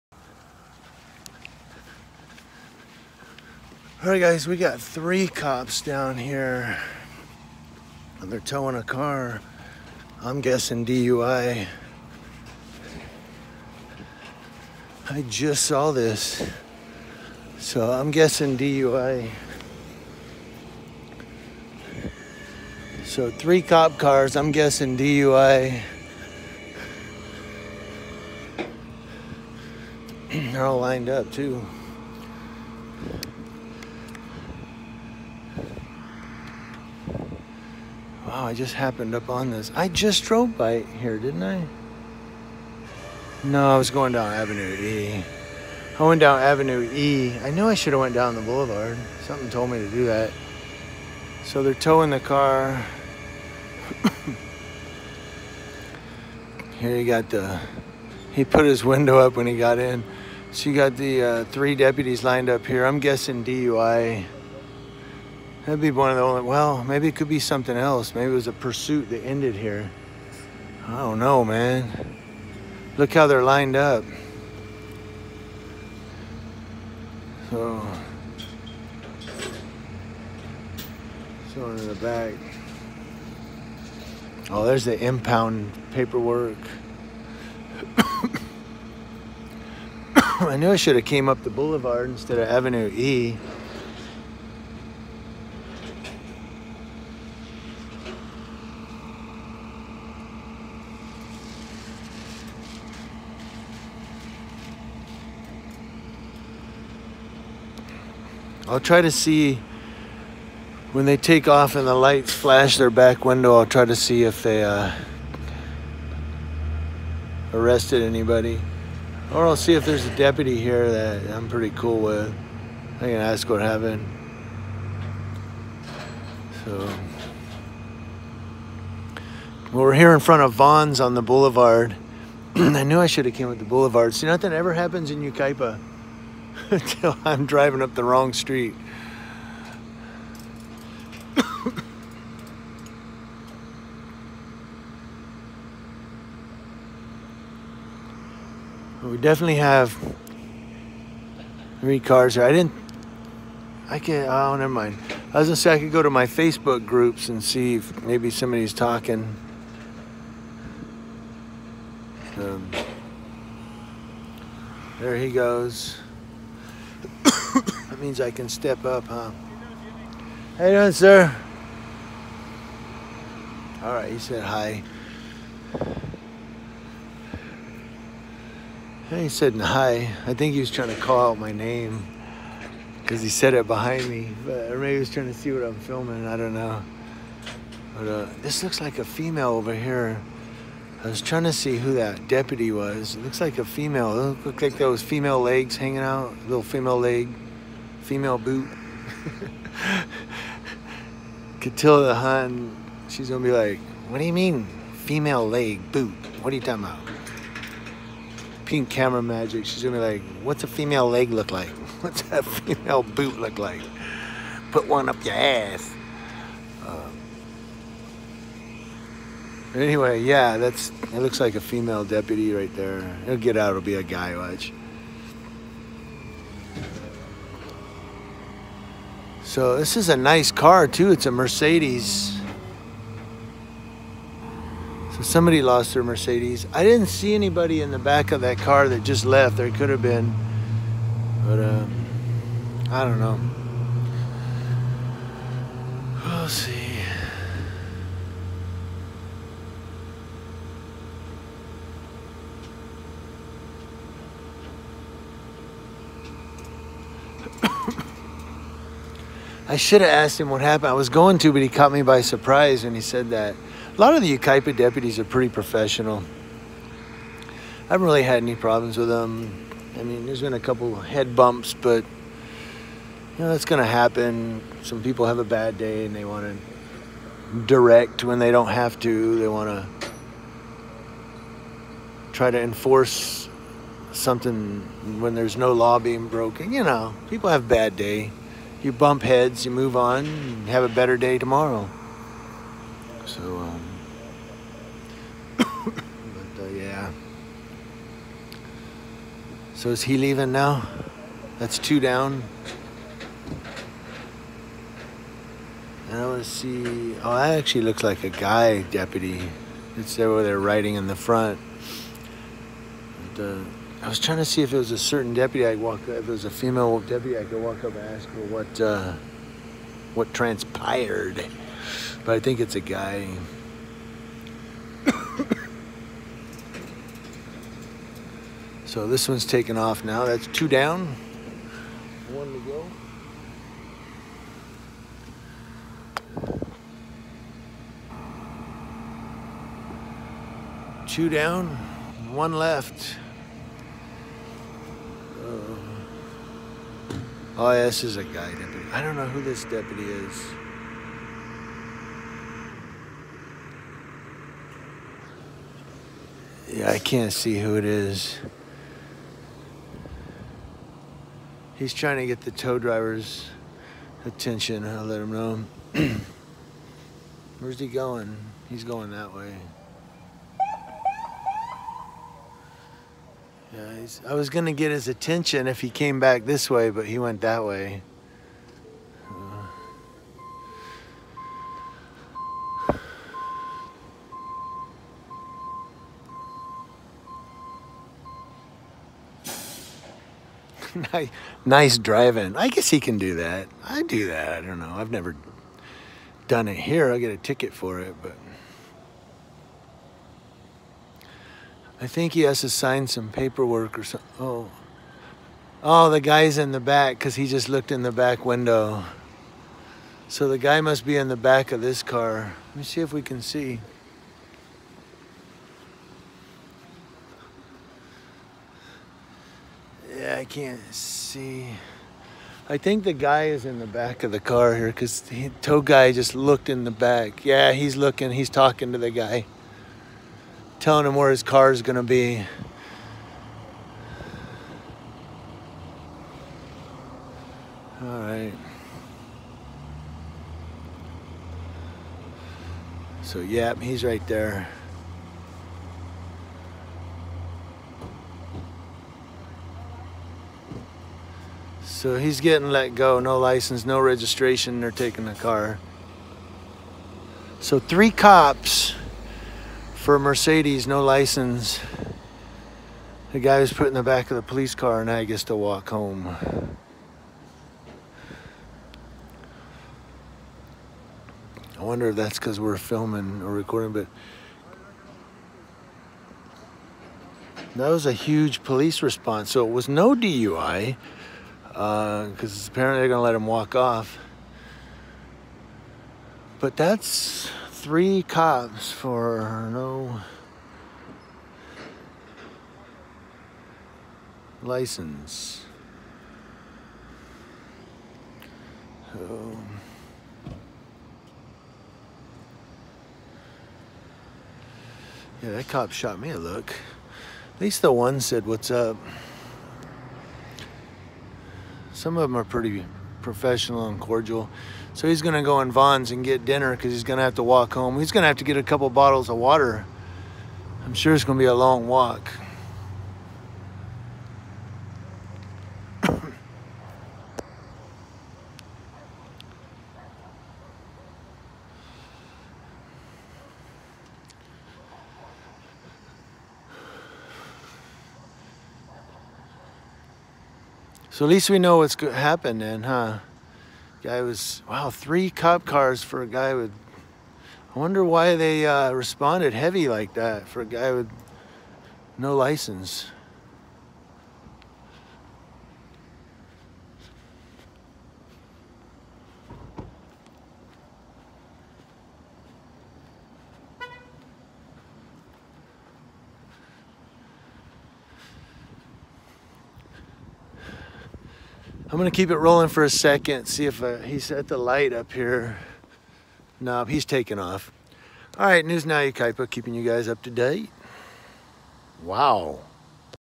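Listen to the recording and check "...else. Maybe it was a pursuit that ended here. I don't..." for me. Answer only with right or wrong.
right.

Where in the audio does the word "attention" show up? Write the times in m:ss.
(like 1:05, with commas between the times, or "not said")
6:04, 6:15.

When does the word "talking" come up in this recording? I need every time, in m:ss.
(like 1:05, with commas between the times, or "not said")
2:38, 3:26, 7:08.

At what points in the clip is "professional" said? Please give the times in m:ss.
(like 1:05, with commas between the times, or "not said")
4:25, 8:33.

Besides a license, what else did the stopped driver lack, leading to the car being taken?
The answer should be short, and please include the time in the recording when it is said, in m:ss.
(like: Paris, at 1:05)
Registration, at 7:33.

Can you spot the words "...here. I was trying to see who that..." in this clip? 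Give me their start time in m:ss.
3:09.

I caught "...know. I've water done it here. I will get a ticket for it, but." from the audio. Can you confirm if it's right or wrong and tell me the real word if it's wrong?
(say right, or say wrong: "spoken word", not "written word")
wrong: "never", not "water".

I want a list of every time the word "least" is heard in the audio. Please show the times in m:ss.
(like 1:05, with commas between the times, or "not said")
8:27, 9:01.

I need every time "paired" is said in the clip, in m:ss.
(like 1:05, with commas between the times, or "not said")
not said.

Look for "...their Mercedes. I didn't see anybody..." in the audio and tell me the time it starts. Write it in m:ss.
3:55.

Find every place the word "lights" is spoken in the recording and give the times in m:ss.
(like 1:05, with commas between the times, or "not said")
1:51, 9:34.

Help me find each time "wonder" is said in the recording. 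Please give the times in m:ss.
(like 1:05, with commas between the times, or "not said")
7:51, 9:07.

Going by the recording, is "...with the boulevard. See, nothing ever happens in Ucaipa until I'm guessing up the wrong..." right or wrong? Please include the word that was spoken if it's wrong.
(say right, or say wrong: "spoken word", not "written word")
wrong: "driving", not "guessing".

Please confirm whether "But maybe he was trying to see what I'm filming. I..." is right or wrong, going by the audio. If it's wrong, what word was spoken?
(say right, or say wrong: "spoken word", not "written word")
right.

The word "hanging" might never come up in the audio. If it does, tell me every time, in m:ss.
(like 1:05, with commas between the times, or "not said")
3:15.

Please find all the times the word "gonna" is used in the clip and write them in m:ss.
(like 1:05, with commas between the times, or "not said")
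2:35, 3:23, 3:29, 6:14, 9:31.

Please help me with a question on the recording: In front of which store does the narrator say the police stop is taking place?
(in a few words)
Vons.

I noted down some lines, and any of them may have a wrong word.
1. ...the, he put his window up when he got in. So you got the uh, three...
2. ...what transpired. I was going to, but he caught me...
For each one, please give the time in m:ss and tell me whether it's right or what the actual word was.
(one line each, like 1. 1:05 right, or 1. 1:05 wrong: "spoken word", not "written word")
1. 0:57 right
2. 4:20 wrong: "happened", not "transpired".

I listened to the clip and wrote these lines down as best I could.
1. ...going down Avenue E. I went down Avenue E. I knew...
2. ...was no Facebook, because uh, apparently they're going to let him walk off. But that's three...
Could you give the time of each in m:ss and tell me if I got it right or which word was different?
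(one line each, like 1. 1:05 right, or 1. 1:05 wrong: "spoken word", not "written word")
1. 0:43 right
2. 7:59 wrong: "DUI", not "Facebook".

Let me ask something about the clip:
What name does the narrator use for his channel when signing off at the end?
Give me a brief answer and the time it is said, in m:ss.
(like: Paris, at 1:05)
News Now Yucaipa, at 9:38.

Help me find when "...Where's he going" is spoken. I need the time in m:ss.
6:07.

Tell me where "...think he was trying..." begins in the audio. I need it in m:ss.
3:00.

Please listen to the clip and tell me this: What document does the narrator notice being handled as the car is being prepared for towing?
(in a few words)
Impound paperwork.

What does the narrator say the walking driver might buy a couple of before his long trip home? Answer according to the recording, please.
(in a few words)
Bottles of water.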